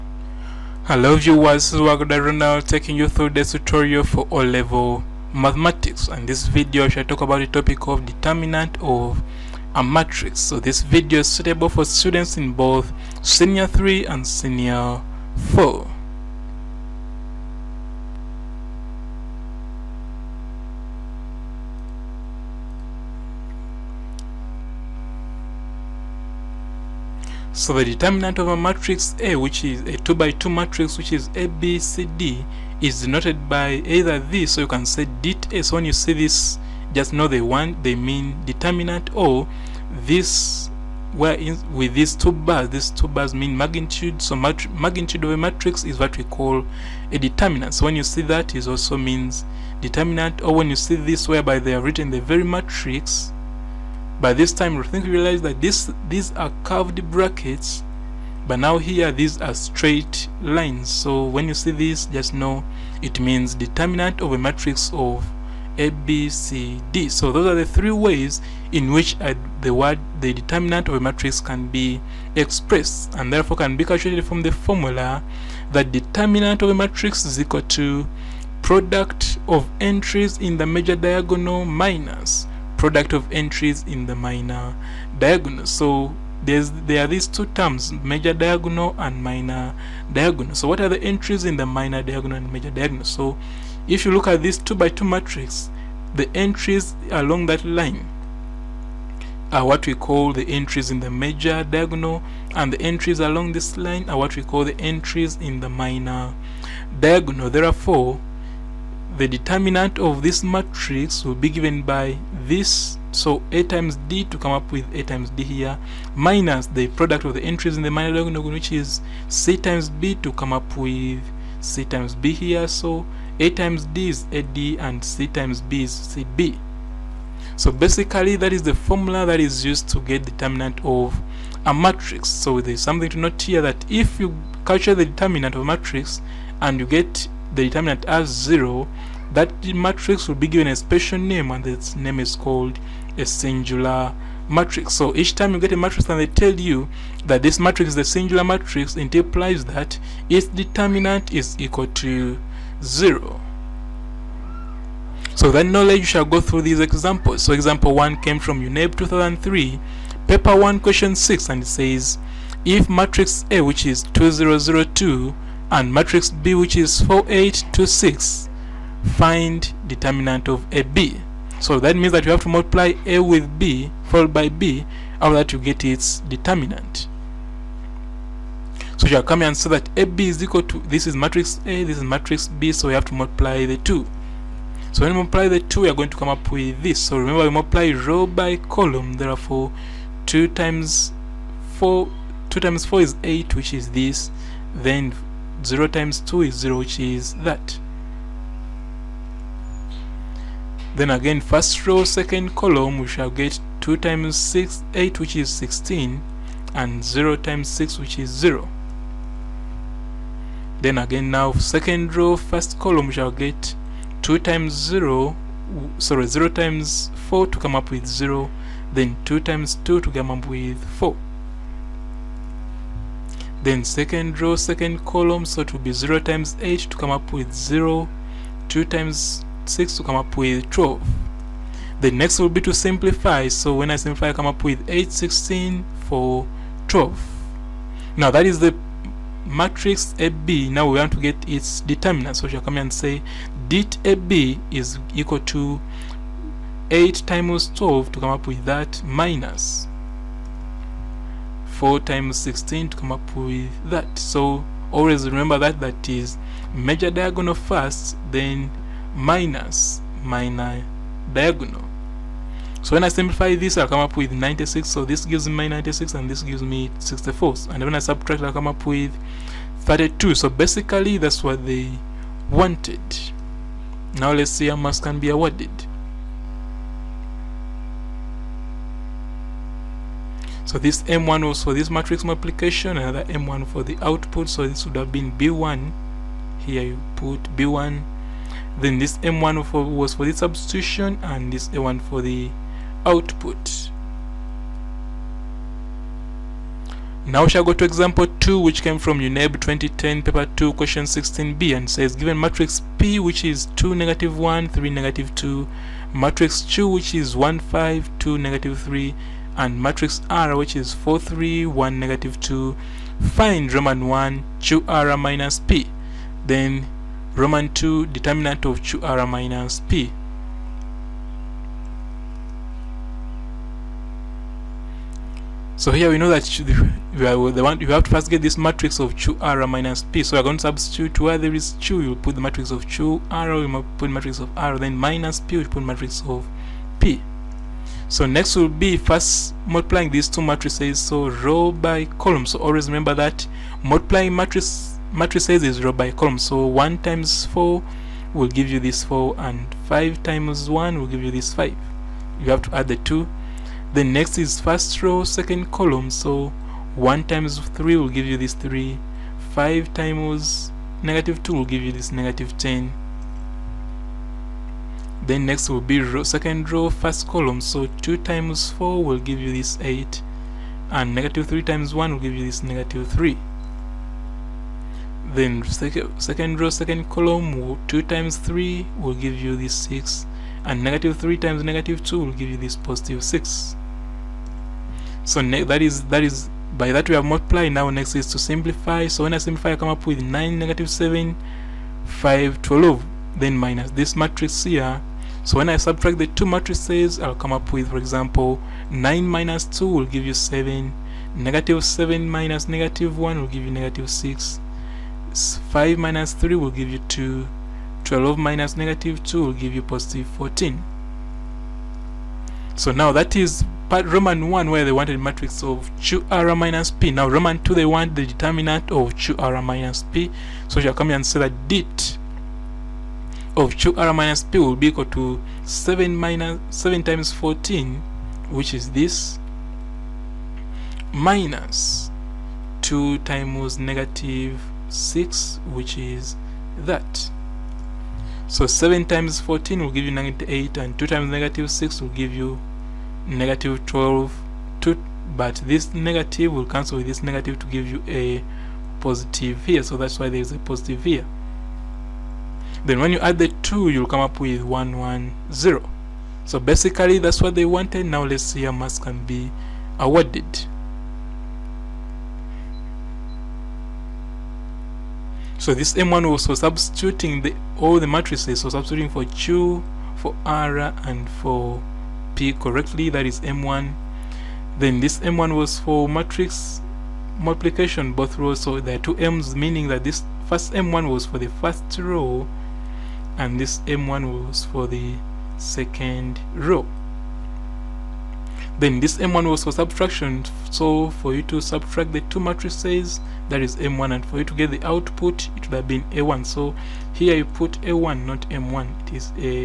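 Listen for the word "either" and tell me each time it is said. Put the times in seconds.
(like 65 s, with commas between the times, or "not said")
33 s.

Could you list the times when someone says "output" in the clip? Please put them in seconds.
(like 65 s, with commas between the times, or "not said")
284 s, 293 s, 494 s.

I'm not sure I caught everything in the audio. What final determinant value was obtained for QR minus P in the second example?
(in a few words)
110.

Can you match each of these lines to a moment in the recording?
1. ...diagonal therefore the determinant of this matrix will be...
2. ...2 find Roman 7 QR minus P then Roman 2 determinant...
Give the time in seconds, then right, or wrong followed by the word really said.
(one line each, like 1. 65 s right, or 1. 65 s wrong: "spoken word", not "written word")
1. 106 s right
2. 312 s wrong: "1", not "7".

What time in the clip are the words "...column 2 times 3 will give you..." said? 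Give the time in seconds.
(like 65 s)
377 s.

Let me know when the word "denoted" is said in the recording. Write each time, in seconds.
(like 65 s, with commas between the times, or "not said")
33 s.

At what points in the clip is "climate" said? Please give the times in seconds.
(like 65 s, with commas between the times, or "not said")
not said.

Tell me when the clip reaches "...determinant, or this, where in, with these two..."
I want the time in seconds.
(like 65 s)
38 s.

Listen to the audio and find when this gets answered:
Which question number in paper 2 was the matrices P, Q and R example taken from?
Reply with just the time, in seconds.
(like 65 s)
301 s.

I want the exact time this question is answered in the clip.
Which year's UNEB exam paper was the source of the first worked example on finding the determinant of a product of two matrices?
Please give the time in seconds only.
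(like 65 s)
158 s.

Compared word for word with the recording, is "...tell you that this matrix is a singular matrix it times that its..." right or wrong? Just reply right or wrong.
wrong.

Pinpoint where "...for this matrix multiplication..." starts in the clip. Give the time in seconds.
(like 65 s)
281 s.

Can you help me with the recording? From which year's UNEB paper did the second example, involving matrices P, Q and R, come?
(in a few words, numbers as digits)
2010.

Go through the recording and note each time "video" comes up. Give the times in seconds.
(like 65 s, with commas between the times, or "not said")
6 s, 10 s.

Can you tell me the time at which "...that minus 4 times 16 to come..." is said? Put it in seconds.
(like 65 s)
248 s.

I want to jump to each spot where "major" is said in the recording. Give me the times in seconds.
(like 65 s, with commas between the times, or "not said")
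80 s, 87 s, 92 s, 101 s, 256 s.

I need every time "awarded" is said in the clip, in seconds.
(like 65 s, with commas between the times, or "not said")
275 s, 459 s.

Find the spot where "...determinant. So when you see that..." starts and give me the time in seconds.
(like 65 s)
47 s.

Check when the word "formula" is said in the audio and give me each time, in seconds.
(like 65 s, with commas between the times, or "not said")
74 s, 128 s.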